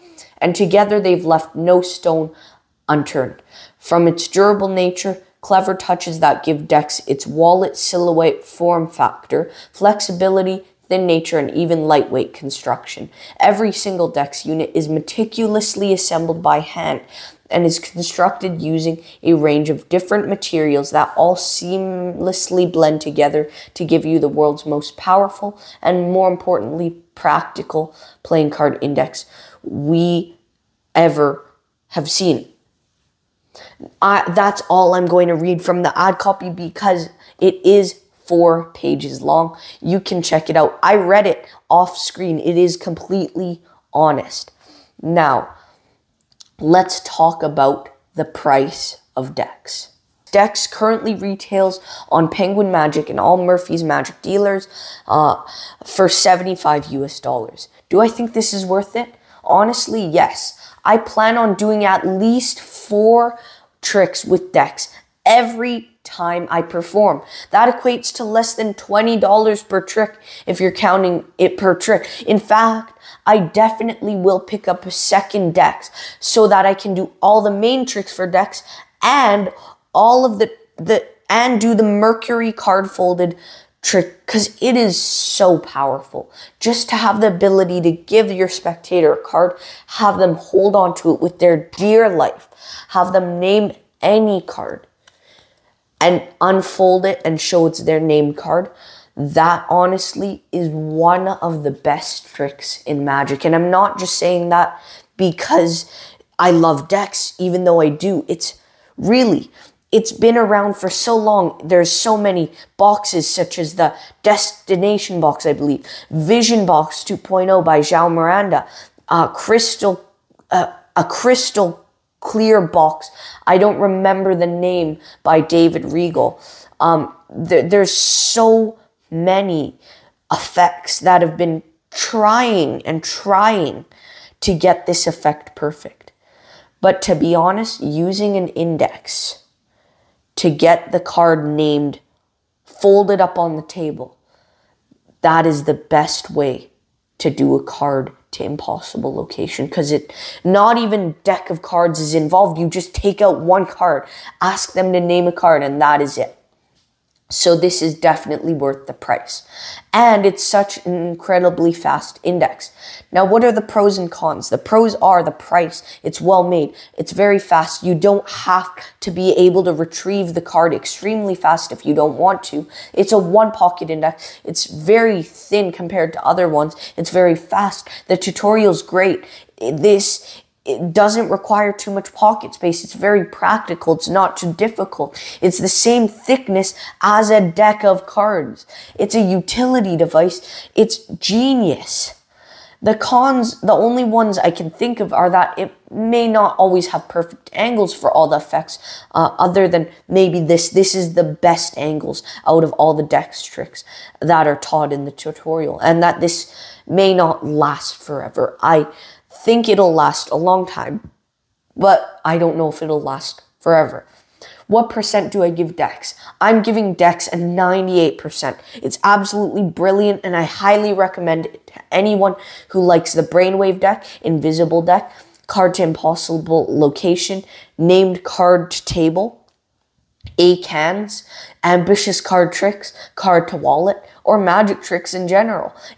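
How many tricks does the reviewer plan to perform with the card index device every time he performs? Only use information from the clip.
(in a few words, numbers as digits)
4.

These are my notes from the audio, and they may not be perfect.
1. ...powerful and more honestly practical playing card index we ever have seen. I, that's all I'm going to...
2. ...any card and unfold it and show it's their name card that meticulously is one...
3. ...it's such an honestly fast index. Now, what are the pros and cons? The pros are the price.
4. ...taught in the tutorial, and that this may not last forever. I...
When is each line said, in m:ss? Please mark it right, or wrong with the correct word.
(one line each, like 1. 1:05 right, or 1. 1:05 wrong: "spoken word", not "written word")
1. 0:24 wrong: "importantly", not "honestly"
2. 1:34 wrong: "honestly", not "meticulously"
3. 2:40 wrong: "incredibly", not "honestly"
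4. 3:24 right.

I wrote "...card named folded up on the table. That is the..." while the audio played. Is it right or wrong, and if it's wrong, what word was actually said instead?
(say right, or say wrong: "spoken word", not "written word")
right.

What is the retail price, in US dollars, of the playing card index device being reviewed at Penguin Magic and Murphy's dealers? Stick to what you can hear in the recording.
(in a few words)
$75.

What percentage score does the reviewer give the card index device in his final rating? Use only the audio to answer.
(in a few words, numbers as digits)
98%.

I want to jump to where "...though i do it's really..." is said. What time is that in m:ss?
1:47.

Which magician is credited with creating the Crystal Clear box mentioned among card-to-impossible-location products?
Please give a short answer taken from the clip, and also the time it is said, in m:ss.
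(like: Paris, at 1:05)
David Regal, at 2:05.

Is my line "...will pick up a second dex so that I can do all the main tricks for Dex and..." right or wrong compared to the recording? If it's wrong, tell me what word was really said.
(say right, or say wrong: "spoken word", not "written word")
right.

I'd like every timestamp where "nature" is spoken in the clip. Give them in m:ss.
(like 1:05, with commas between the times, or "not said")
0:04, 0:11.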